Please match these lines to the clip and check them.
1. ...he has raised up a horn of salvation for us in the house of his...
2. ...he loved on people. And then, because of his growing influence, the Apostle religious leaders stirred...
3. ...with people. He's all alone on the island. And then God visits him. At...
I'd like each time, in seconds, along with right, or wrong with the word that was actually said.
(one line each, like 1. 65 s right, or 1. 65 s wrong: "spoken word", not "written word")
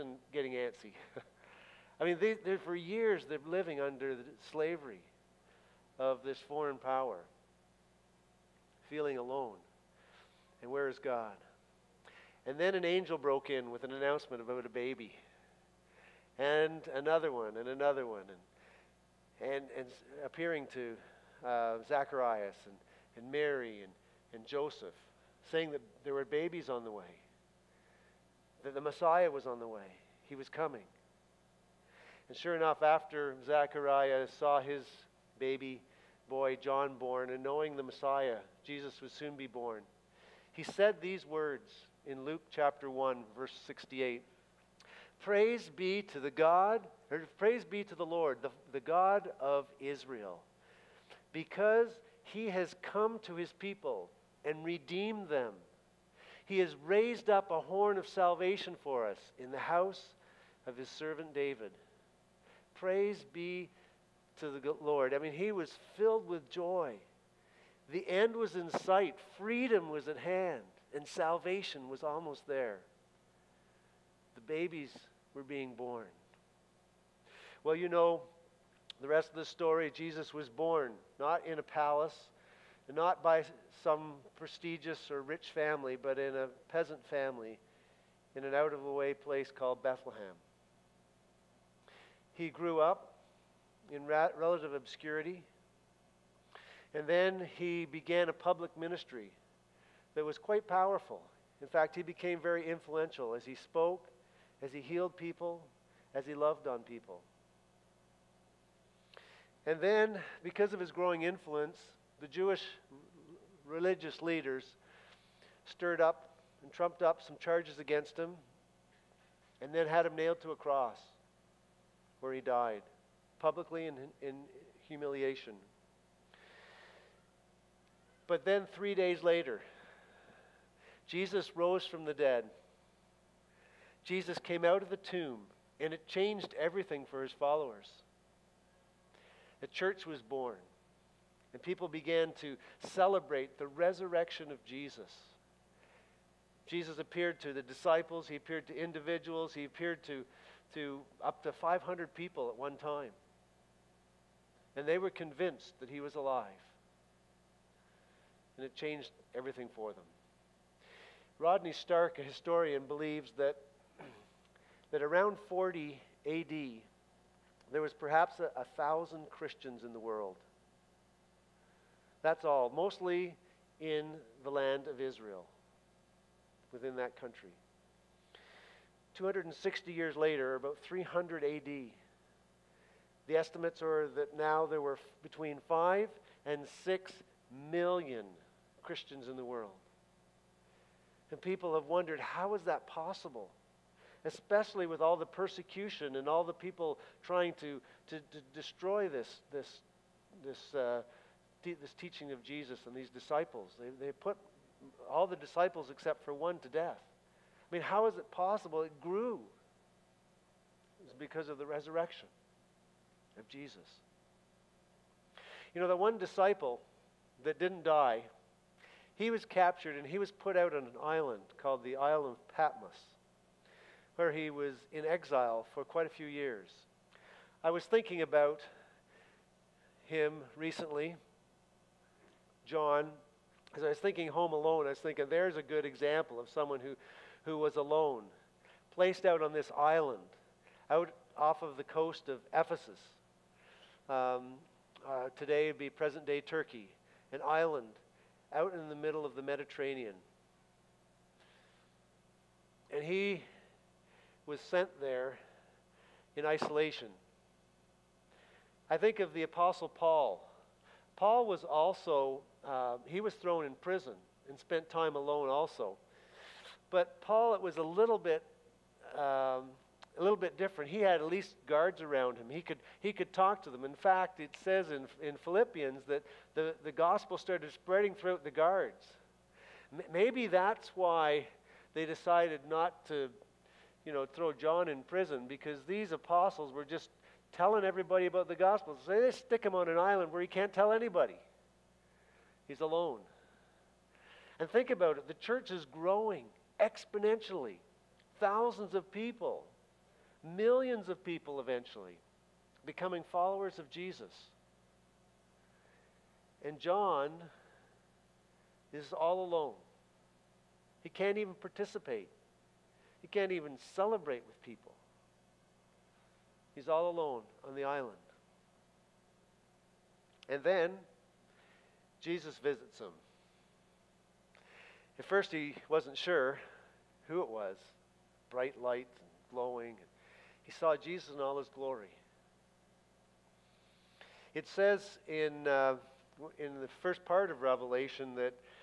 1. 56 s right
2. 106 s wrong: "Jewish", not "Apostle"
3. 314 s wrong: "Jesus", not "God".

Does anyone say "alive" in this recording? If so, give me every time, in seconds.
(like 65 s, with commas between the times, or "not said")
156 s.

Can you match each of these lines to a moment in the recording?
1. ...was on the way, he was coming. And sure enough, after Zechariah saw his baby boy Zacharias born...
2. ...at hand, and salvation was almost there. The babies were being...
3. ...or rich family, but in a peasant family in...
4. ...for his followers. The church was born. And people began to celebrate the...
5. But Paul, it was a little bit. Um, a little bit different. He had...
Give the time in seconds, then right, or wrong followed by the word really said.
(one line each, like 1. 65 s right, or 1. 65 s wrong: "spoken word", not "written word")
1. 29 s wrong: "John", not "Zacharias"
2. 70 s right
3. 85 s right
4. 137 s right
5. 266 s right.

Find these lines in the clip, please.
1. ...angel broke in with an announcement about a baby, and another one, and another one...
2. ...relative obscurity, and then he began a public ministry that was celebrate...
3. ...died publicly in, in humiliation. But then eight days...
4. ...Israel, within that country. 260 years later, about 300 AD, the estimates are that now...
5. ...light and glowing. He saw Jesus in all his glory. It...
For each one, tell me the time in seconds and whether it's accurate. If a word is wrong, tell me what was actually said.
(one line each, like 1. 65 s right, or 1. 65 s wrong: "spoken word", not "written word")
1. 12 s right
2. 94 s wrong: "quite", not "celebrate"
3. 122 s wrong: "three", not "eight"
4. 174 s right
5. 328 s right.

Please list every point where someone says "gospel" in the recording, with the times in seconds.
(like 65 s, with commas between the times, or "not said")
276 s, 288 s.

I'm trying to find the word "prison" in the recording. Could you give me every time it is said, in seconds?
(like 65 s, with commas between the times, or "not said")
263 s, 285 s.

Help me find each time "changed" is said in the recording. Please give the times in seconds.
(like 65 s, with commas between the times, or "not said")
136 s, 158 s.